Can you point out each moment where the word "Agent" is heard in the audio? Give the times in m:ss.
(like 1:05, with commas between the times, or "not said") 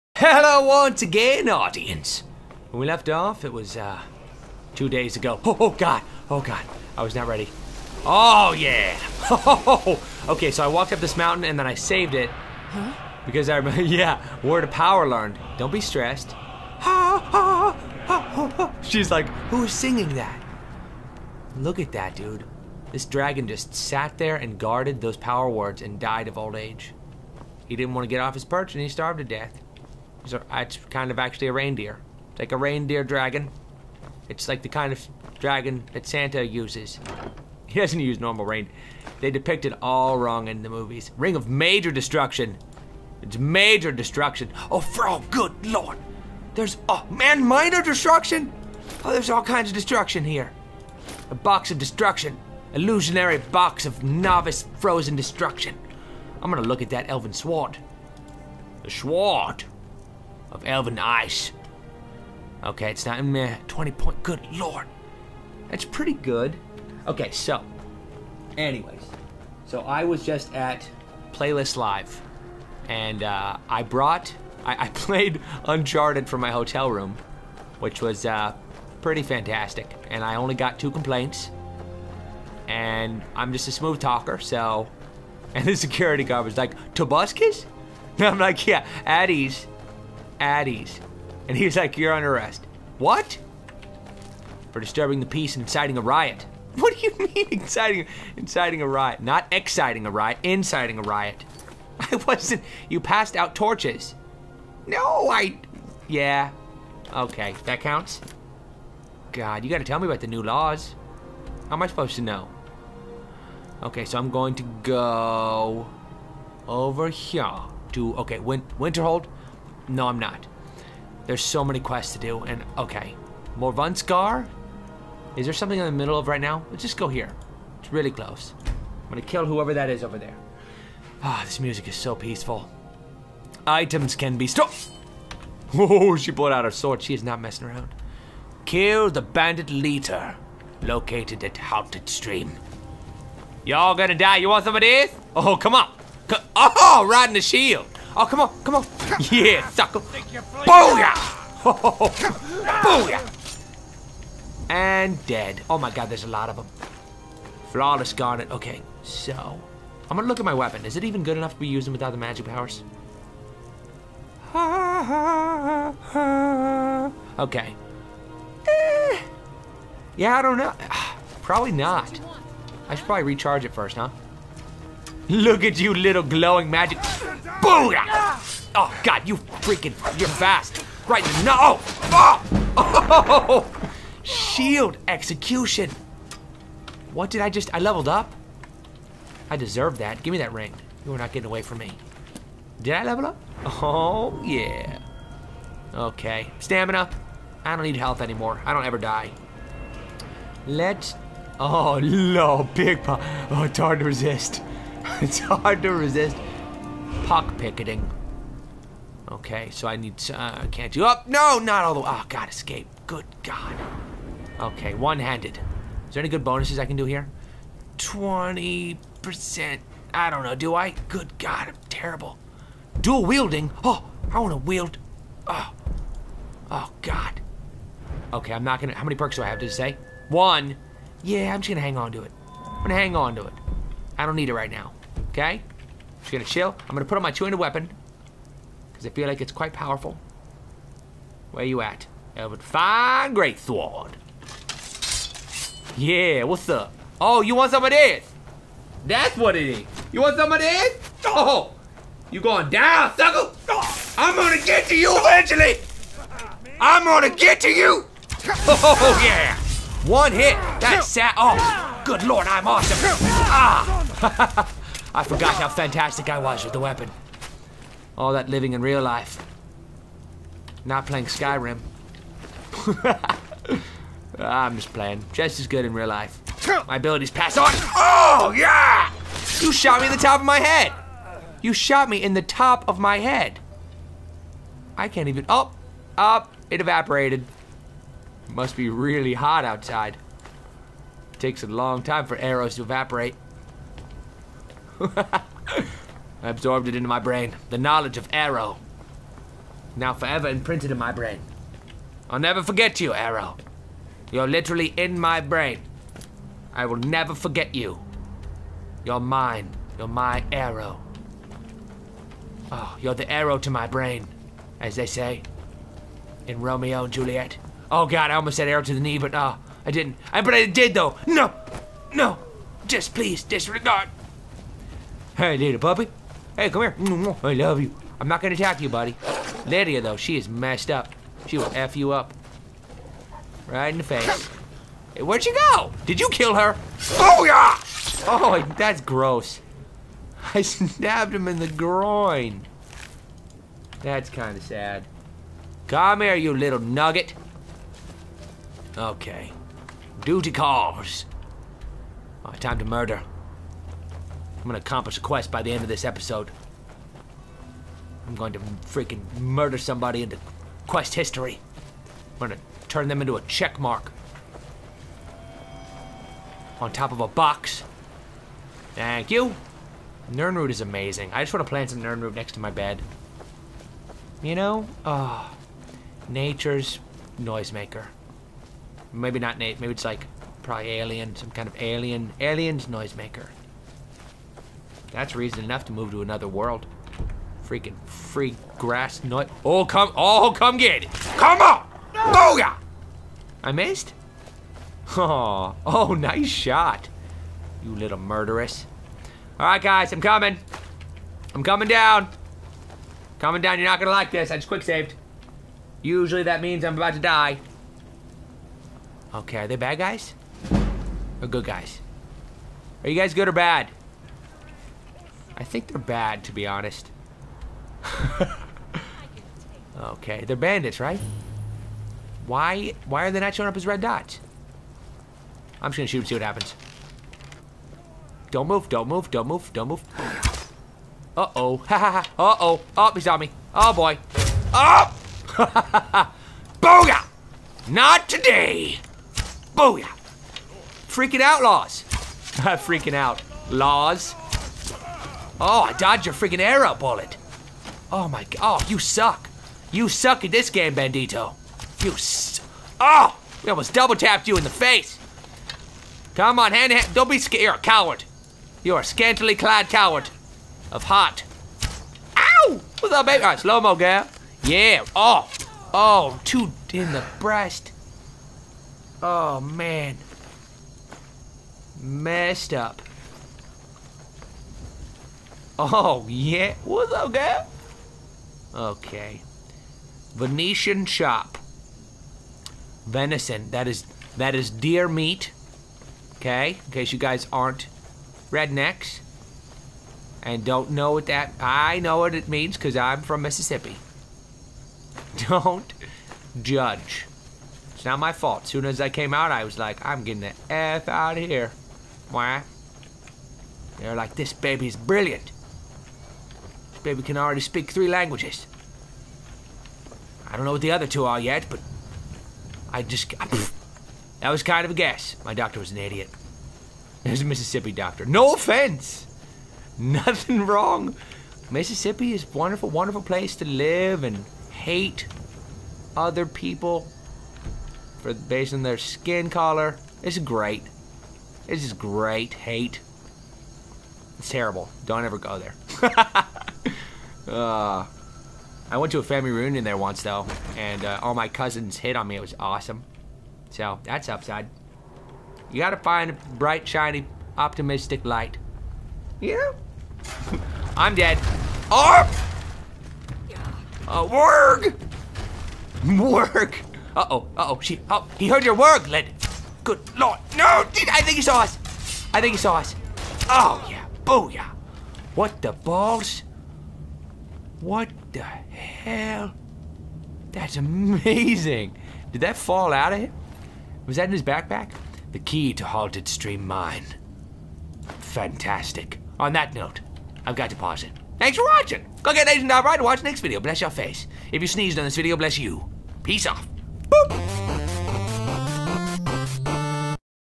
9:42.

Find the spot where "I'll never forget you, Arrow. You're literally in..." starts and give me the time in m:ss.
5:02.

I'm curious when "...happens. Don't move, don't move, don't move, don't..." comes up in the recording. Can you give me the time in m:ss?
7:06.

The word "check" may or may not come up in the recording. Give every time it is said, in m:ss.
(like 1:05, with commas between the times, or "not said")
6:03.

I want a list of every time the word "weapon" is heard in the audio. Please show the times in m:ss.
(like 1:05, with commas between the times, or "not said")
2:40, 3:57, 4:26.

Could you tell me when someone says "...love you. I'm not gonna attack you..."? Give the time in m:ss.
5:27.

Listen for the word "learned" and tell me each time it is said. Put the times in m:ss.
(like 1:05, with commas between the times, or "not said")
0:15.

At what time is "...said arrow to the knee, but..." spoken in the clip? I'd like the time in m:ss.
5:18.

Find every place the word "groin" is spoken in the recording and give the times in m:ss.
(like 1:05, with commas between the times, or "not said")
5:41.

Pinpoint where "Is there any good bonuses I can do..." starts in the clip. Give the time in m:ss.
3:36.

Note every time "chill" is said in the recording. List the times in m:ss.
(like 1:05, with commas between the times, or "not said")
3:56.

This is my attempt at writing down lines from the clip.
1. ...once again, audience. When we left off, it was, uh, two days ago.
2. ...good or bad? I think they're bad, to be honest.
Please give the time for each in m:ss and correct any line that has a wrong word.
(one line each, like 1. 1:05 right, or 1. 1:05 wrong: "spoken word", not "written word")
1. 0:00 right
2. 6:53 right.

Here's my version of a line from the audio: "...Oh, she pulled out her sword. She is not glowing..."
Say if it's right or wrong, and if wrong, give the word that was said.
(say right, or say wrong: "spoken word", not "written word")
wrong: "messing", not "glowing".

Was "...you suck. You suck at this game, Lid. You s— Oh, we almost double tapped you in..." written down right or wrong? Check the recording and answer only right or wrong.
wrong.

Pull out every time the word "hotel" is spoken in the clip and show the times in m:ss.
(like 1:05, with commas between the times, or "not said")
1:16.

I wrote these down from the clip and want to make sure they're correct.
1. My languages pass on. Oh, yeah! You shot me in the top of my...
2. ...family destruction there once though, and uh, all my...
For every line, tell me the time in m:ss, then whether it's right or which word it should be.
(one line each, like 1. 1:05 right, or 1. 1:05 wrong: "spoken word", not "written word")
1. 4:36 wrong: "abilities", not "languages"
2. 8:59 wrong: "reunion", not "destruction".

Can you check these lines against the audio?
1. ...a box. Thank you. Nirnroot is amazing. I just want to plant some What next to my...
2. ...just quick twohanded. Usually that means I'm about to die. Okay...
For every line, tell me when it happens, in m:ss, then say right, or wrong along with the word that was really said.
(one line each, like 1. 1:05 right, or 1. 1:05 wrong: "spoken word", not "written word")
1. 6:07 wrong: "Nirnroot", not "What"
2. 6:44 wrong: "saved", not "twohanded".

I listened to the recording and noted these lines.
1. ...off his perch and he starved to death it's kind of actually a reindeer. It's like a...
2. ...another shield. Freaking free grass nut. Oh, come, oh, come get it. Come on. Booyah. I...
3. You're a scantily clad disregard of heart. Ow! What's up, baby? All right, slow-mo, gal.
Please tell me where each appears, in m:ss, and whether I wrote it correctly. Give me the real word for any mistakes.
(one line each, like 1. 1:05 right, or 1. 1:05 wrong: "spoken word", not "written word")
1. 0:28 right
2. 6:26 wrong: "world", not "shield"
3. 7:38 wrong: "coward", not "disregard".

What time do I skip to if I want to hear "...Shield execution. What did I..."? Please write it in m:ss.
3:04.